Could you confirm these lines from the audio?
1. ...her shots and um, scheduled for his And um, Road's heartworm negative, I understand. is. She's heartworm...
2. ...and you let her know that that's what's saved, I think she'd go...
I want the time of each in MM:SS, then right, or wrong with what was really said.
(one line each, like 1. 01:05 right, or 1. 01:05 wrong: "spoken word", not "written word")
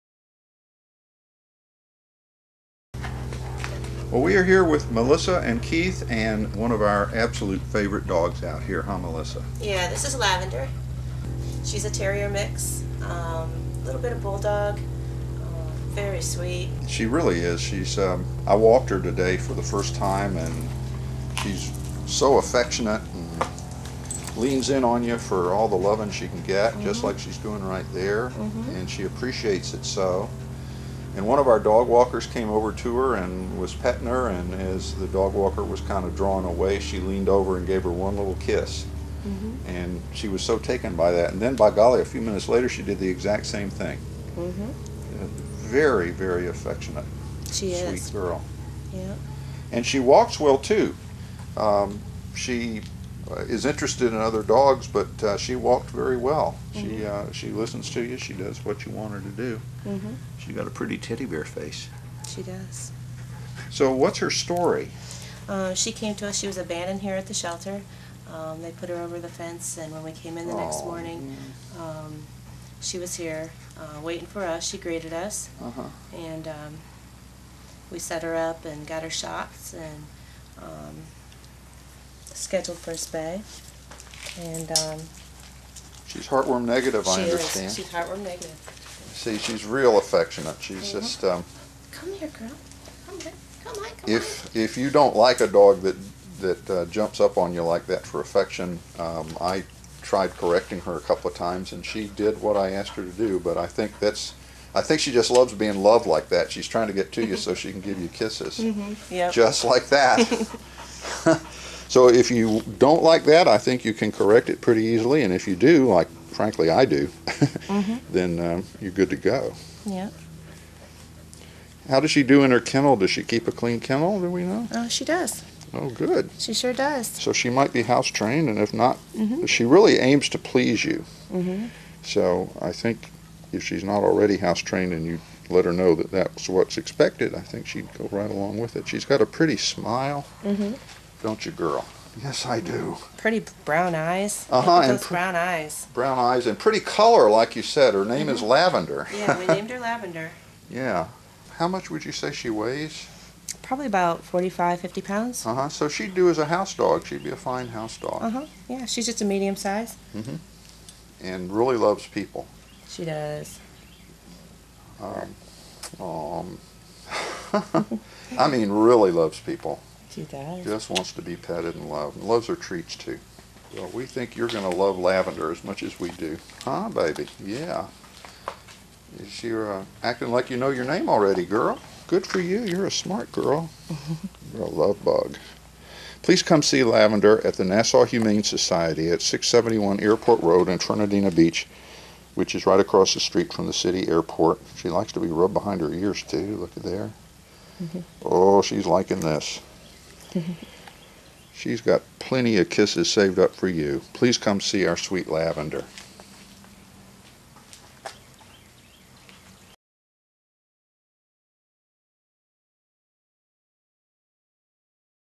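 1. 01:19 wrong: "She", not "Road"
2. 02:14 wrong: "expected", not "saved".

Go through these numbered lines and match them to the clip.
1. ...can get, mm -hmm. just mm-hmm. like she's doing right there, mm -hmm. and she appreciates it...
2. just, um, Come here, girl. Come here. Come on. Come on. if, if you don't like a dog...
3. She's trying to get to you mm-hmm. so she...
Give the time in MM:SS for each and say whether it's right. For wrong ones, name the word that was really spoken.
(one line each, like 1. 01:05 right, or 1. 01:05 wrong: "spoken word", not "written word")
1. 00:26 right
2. 01:30 right
3. 01:46 right.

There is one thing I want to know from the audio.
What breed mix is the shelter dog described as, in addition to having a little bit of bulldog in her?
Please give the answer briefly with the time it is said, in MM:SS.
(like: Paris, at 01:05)
Terrier mix, at 00:11.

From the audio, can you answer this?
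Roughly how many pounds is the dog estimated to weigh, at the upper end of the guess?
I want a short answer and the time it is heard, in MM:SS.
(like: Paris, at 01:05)
50 pounds, at 02:34.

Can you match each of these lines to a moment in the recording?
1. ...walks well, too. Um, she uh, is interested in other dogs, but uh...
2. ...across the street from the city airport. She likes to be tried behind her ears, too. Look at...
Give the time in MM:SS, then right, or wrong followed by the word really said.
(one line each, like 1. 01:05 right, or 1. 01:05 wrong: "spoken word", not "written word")
1. 00:49 right
2. 03:12 wrong: "rubbed", not "tried".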